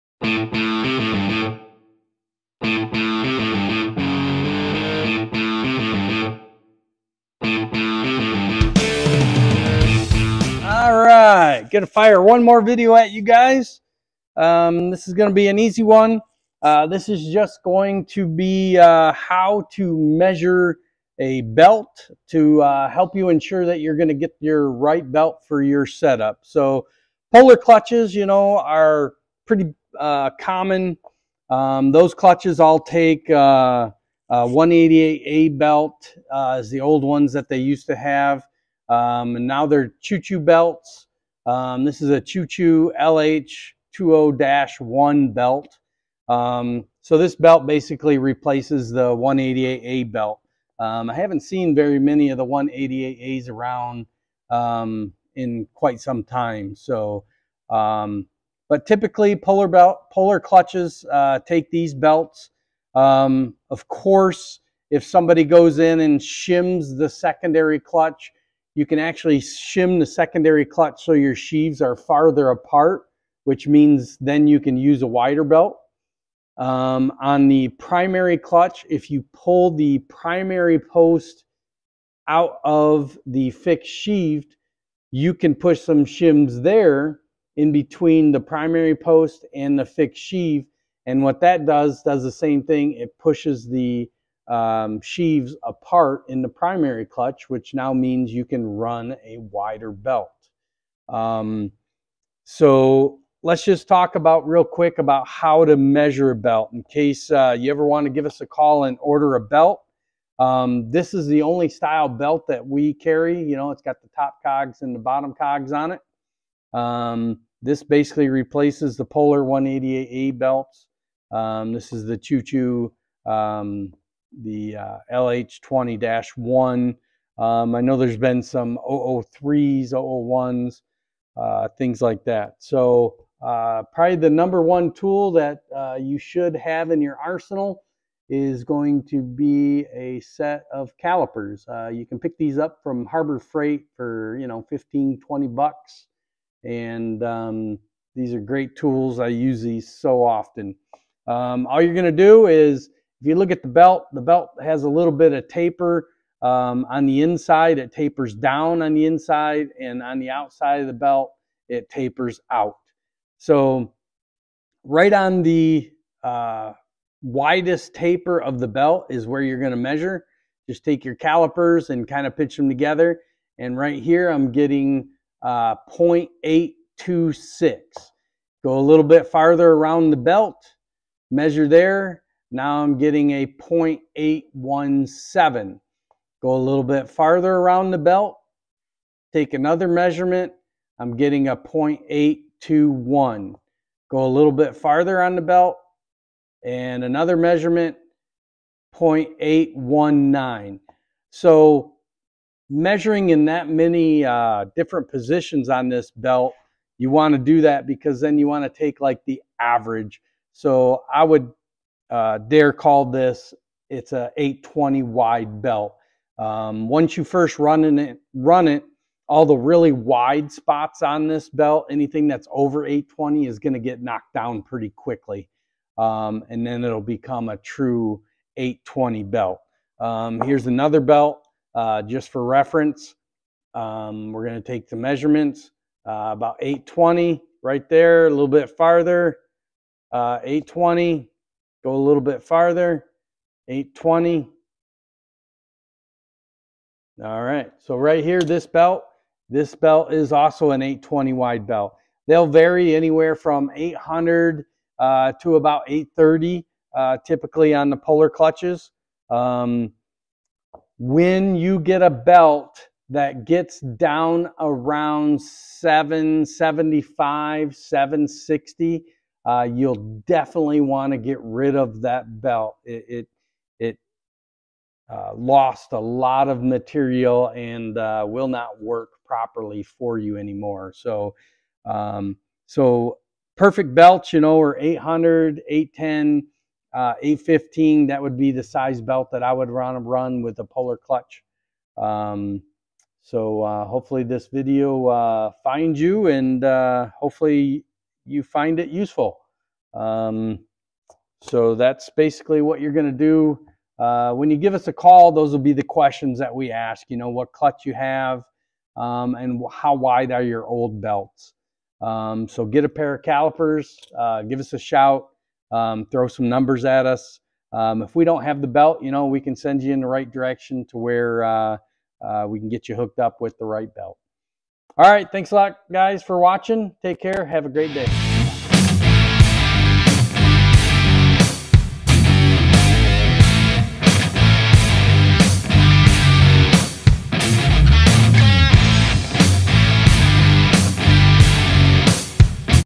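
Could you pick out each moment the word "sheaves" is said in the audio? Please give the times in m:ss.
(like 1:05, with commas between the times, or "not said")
1:11, 1:23, 1:30, 1:34.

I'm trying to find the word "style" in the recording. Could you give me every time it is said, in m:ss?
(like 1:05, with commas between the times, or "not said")
1:51.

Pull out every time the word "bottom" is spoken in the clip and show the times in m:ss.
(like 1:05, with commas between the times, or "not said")
1:54.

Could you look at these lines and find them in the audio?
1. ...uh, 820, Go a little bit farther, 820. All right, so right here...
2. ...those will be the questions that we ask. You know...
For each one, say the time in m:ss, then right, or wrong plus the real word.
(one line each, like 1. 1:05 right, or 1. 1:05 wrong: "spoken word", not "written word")
1. 4:00 right
2. 5:05 right.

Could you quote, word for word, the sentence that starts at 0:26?
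So polar clutches, you know, are pretty uh, common.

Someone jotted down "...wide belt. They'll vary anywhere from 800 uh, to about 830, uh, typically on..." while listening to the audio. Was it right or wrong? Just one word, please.
right.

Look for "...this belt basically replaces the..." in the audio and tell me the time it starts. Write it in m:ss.
0:47.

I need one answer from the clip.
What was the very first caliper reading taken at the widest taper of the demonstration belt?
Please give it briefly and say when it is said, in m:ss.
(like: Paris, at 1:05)
0.826, at 2:55.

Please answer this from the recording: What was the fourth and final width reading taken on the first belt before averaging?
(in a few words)
0.819.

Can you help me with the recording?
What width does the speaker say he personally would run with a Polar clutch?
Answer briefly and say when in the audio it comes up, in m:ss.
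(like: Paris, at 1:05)
815, at 4:47.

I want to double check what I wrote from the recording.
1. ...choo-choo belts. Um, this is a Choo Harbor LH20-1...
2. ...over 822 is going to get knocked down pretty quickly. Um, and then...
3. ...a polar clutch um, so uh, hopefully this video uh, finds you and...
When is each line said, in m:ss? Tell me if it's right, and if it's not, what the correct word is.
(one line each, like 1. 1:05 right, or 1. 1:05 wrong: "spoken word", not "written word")
1. 0:40 wrong: "Choo", not "Harbor"
2. 3:42 wrong: "820", not "822"
3. 4:50 right.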